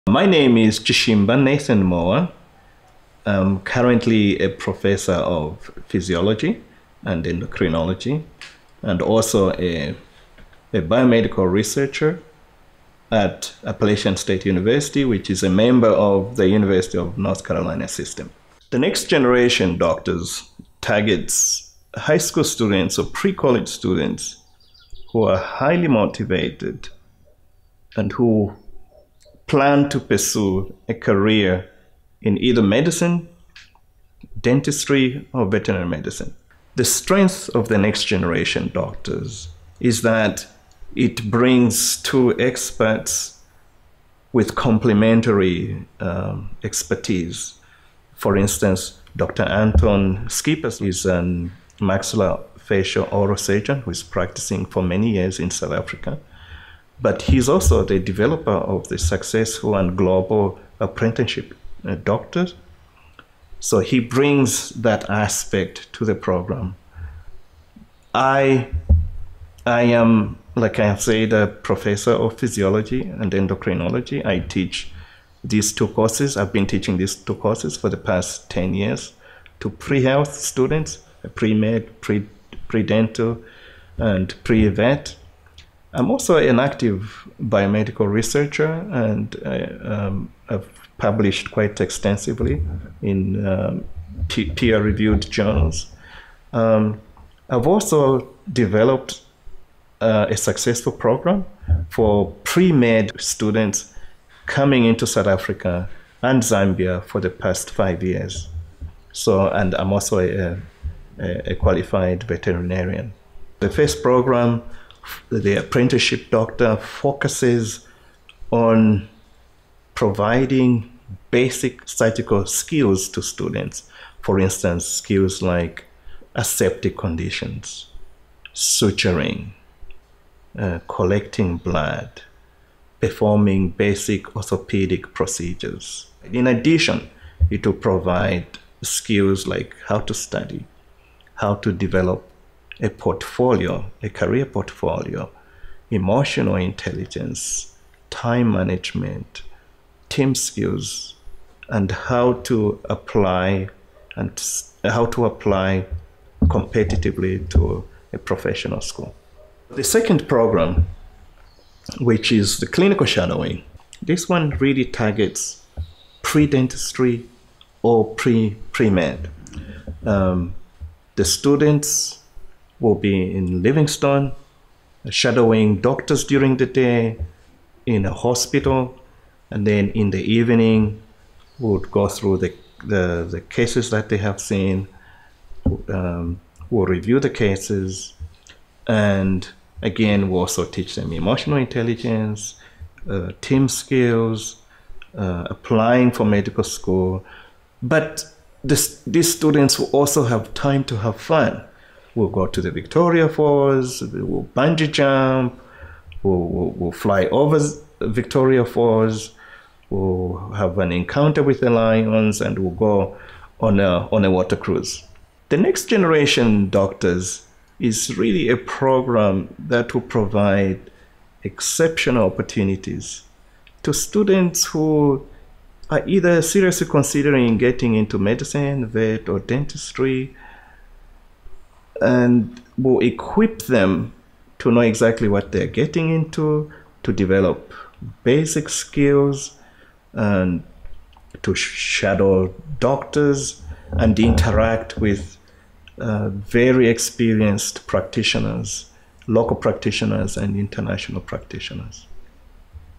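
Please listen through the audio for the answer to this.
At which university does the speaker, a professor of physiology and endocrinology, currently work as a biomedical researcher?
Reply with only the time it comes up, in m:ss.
0:13.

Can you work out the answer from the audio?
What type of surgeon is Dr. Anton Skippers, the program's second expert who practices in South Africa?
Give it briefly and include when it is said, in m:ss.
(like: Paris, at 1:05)
Maxillofacial oral surgeon, at 0:51.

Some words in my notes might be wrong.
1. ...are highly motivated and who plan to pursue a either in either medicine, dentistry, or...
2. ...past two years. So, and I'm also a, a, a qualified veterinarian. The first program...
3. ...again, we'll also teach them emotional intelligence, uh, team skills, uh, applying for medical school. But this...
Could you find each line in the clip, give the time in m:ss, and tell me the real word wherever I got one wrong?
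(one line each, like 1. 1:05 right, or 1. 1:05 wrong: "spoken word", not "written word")
1. 0:25 wrong: "career", not "either"
2. 1:47 wrong: "five", not "two"
3. 3:09 right.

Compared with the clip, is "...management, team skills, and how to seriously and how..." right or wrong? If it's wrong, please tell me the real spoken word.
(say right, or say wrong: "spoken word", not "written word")
wrong: "apply", not "seriously".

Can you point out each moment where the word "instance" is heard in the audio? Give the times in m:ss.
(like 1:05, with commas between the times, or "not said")
0:48, 2:04.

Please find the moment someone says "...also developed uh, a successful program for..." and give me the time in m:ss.
1:37.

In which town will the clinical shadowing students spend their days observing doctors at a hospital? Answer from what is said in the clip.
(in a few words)
Livingstone.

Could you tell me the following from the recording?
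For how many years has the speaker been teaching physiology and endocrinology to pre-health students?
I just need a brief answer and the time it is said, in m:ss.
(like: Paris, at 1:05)
10, at 1:18.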